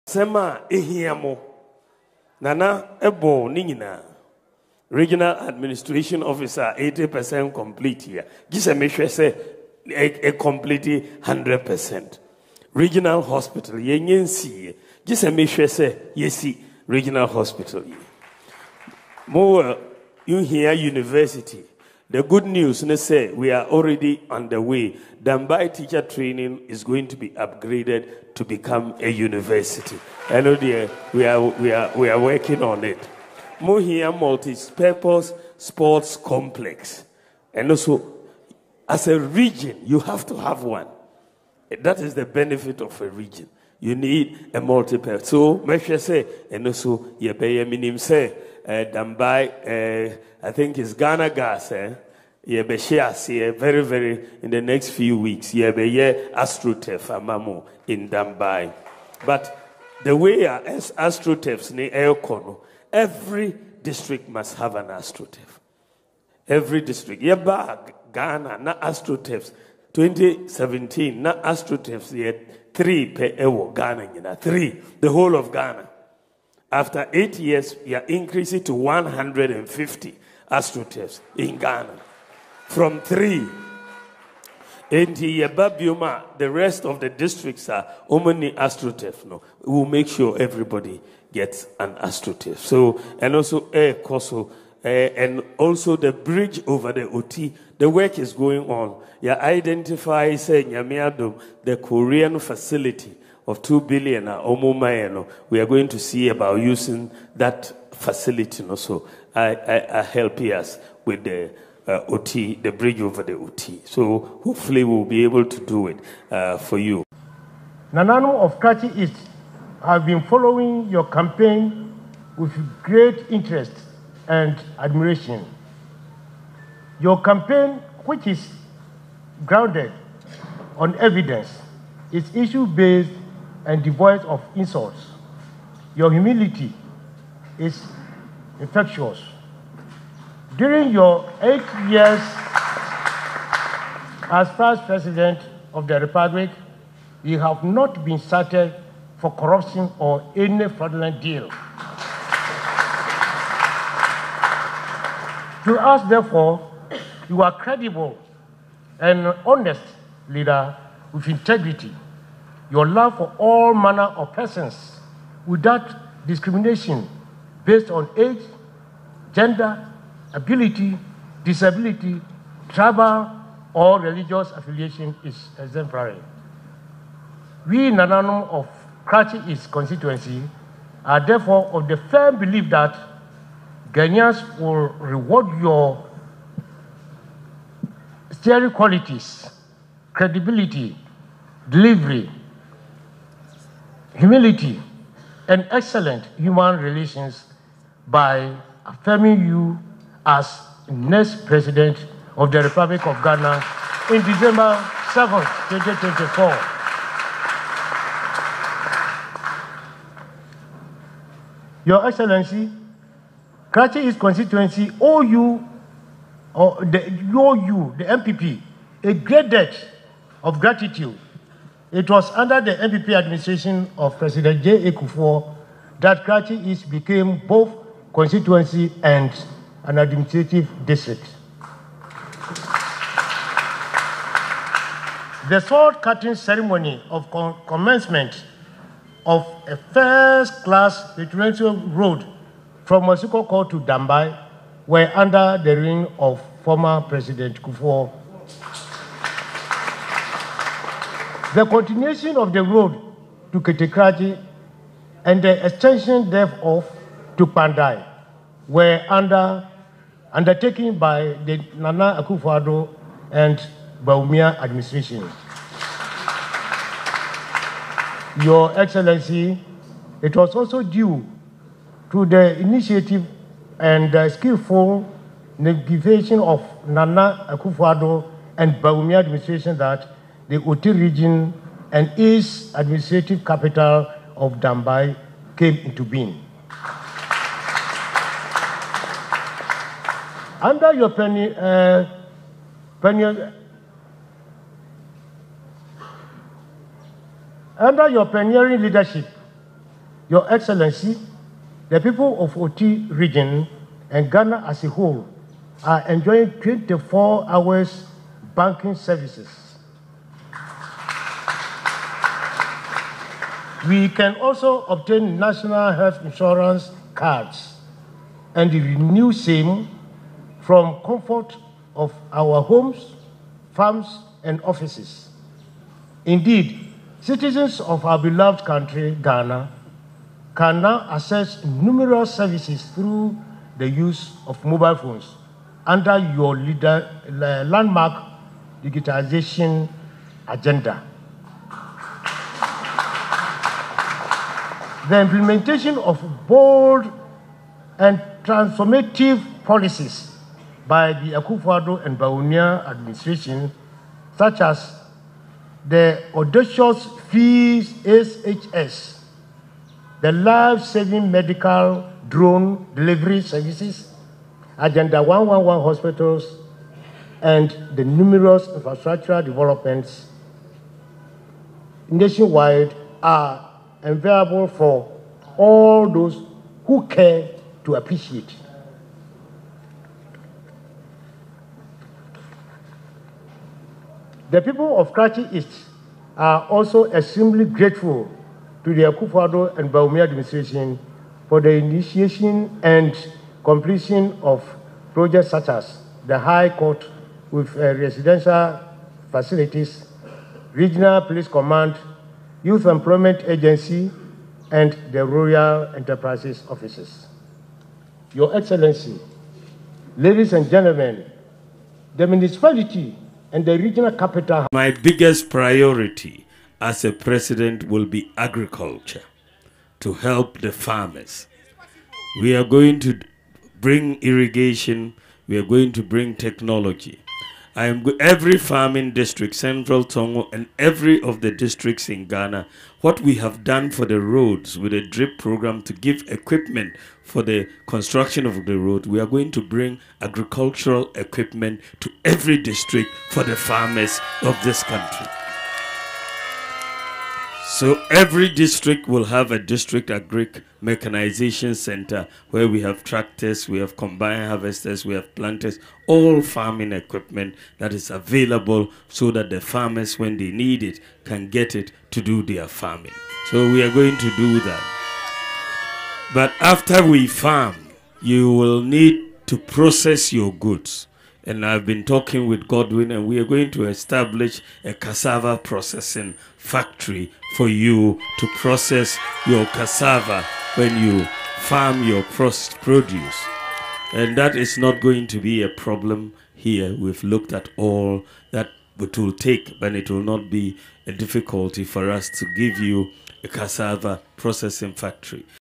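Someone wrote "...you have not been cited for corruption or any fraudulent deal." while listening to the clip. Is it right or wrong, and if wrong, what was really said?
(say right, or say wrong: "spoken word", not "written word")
right.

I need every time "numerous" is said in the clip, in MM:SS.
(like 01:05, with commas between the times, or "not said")
05:31, 06:08.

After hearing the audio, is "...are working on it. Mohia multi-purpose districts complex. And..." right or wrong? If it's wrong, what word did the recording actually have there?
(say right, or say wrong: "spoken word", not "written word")
wrong: "sports", not "districts".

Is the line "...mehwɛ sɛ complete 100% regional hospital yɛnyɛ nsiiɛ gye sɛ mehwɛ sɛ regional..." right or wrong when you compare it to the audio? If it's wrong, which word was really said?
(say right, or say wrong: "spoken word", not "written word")
right.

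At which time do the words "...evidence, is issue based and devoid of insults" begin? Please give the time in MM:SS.
02:10.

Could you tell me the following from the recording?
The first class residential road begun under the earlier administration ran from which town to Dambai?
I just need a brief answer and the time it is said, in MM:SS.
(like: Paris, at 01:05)
Masukoko, at 04:03.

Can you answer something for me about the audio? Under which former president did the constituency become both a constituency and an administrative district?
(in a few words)
J. Kufuor.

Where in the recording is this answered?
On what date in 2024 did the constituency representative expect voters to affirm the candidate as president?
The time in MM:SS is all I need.
03:24.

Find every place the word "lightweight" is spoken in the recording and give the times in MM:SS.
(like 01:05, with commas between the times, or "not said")
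not said.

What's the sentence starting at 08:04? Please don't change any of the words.
And that is not going to be a problem here.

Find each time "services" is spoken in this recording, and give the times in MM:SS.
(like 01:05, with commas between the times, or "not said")
05:08, 05:32, 06:03.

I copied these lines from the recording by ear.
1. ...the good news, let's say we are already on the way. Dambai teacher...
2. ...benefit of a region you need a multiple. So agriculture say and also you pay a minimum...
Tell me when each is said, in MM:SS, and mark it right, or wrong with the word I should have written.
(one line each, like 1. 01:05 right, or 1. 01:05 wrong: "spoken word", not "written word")
1. 00:22 right
2. 00:42 wrong: "measure", not "agriculture".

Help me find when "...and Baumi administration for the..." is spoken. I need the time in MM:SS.
06:29.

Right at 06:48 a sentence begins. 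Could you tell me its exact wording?
Your Excellency, ladies and gentlemen, the municipality and the regional capital.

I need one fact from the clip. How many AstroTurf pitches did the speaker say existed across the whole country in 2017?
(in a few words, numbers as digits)
3.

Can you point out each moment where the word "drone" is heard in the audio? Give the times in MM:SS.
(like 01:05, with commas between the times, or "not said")
06:02.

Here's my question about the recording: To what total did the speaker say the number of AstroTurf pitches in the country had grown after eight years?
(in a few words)
150.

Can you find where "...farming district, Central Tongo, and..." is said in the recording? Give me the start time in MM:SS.
07:08.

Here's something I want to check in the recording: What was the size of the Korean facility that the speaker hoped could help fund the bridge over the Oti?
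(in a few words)
2 billion.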